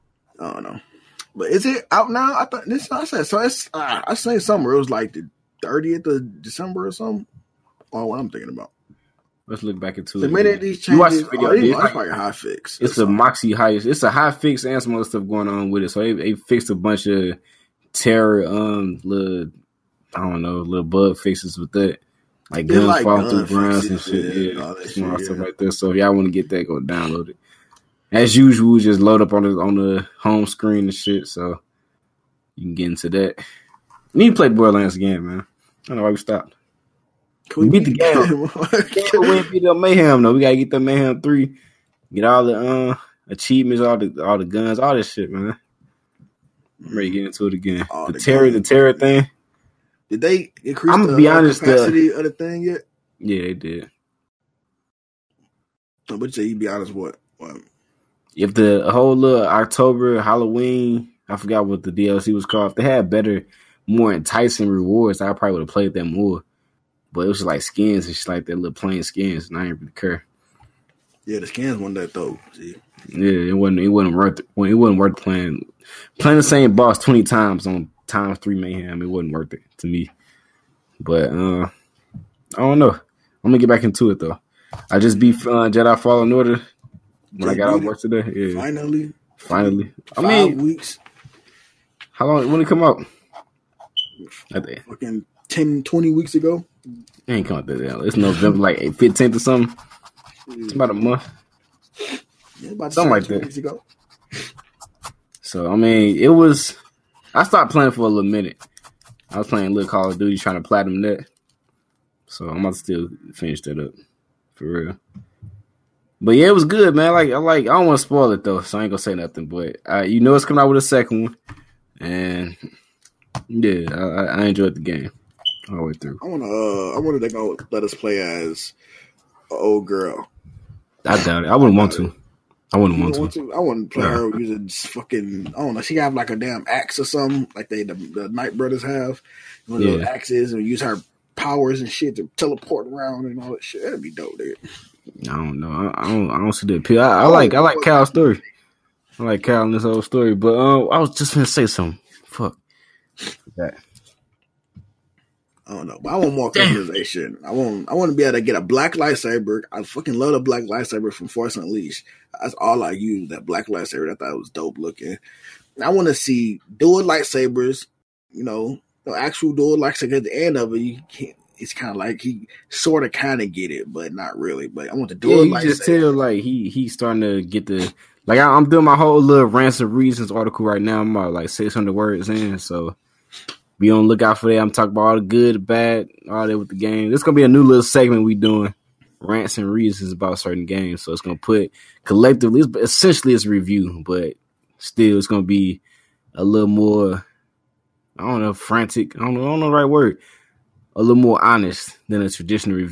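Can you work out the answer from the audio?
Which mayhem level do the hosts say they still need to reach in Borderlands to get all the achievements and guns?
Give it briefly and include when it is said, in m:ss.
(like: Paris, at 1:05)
Mayhem 3, at 0:40.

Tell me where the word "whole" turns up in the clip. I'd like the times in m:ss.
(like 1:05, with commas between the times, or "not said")
0:58, 2:29, 2:58.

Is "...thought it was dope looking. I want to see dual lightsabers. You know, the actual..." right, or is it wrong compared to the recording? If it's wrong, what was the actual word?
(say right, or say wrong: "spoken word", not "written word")
right.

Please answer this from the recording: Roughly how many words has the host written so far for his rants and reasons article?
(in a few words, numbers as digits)
600.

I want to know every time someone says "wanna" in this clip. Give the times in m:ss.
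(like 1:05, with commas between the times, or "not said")
2:06.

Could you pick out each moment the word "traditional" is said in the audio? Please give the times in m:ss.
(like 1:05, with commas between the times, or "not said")
3:22.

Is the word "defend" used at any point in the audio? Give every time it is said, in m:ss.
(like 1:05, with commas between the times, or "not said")
not said.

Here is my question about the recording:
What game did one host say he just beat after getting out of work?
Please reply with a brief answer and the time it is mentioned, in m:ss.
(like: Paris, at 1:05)
Jedi Fallen Order, at 1:25.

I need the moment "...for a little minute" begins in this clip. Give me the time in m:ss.
1:47.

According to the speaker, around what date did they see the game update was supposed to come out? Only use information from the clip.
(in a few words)
30th of December.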